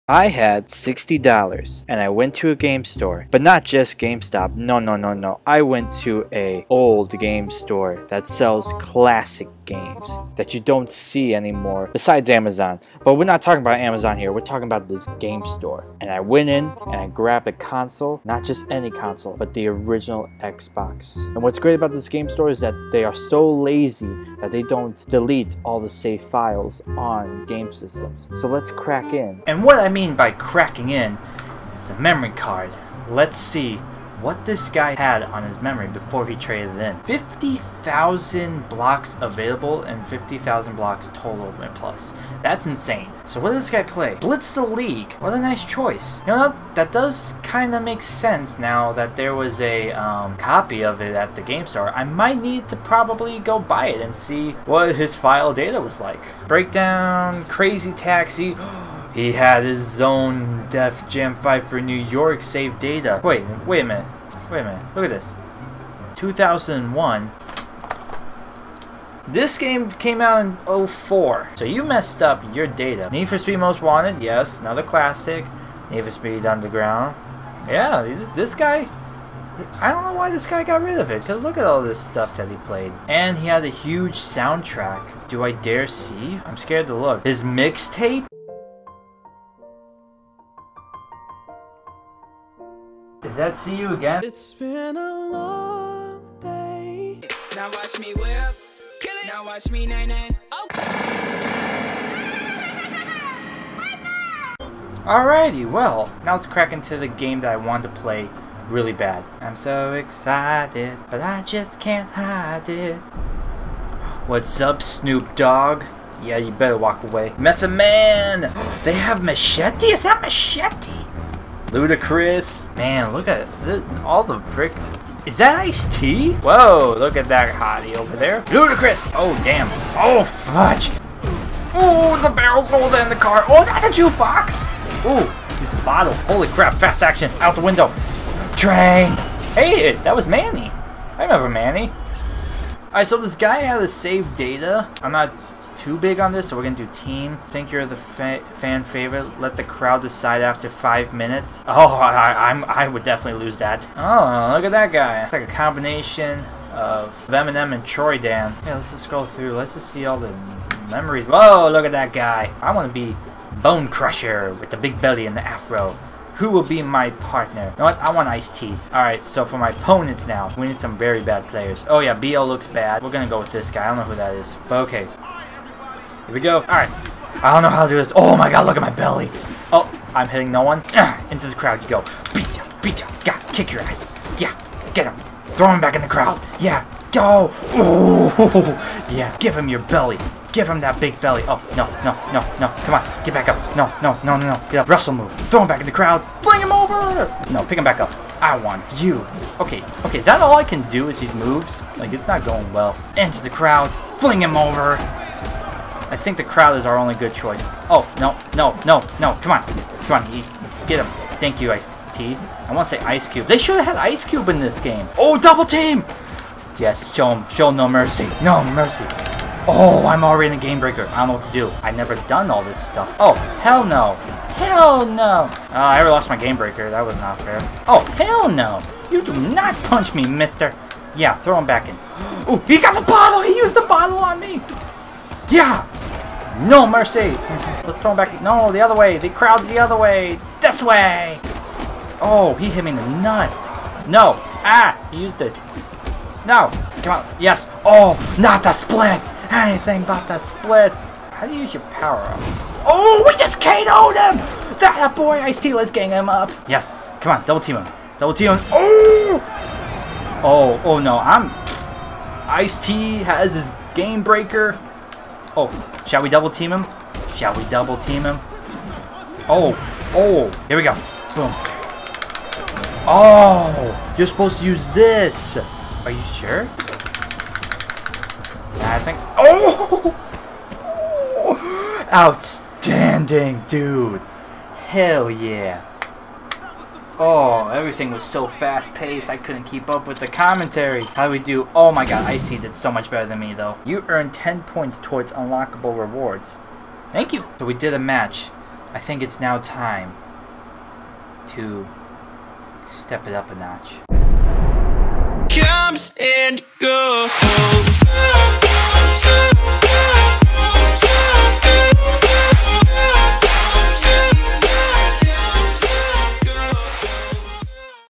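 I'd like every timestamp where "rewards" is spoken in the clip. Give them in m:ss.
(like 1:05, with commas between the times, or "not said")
4:55.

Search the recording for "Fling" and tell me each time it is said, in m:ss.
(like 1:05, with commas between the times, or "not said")
3:16, 3:24.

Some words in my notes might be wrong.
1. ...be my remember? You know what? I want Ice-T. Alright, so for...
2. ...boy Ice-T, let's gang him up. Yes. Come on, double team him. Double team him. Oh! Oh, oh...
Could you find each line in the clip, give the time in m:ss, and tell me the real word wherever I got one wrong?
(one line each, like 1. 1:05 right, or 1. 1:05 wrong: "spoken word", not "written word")
1. 2:46 wrong: "partner", not "remember"
2. 4:15 right.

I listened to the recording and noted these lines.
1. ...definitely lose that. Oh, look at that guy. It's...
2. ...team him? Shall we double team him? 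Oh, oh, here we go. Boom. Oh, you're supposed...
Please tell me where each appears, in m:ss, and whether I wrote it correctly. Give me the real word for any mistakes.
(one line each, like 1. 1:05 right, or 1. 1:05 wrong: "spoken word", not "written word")
1. 2:33 right
2. 4:26 right.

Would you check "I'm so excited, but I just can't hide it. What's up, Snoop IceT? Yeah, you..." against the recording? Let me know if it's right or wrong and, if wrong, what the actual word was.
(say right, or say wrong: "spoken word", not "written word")
wrong: "Dogg", not "IceT".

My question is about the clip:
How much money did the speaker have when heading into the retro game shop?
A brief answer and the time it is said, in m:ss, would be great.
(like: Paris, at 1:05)
$60, at 0:00.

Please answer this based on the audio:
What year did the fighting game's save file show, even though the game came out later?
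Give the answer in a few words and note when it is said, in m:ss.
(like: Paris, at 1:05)
2001, at 1:06.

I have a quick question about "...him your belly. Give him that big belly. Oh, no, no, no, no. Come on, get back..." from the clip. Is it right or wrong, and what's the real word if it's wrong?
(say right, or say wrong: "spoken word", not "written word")
right.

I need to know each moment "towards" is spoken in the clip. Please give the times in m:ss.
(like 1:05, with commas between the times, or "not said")
4:54.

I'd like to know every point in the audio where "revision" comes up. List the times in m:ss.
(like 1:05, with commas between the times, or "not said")
not said.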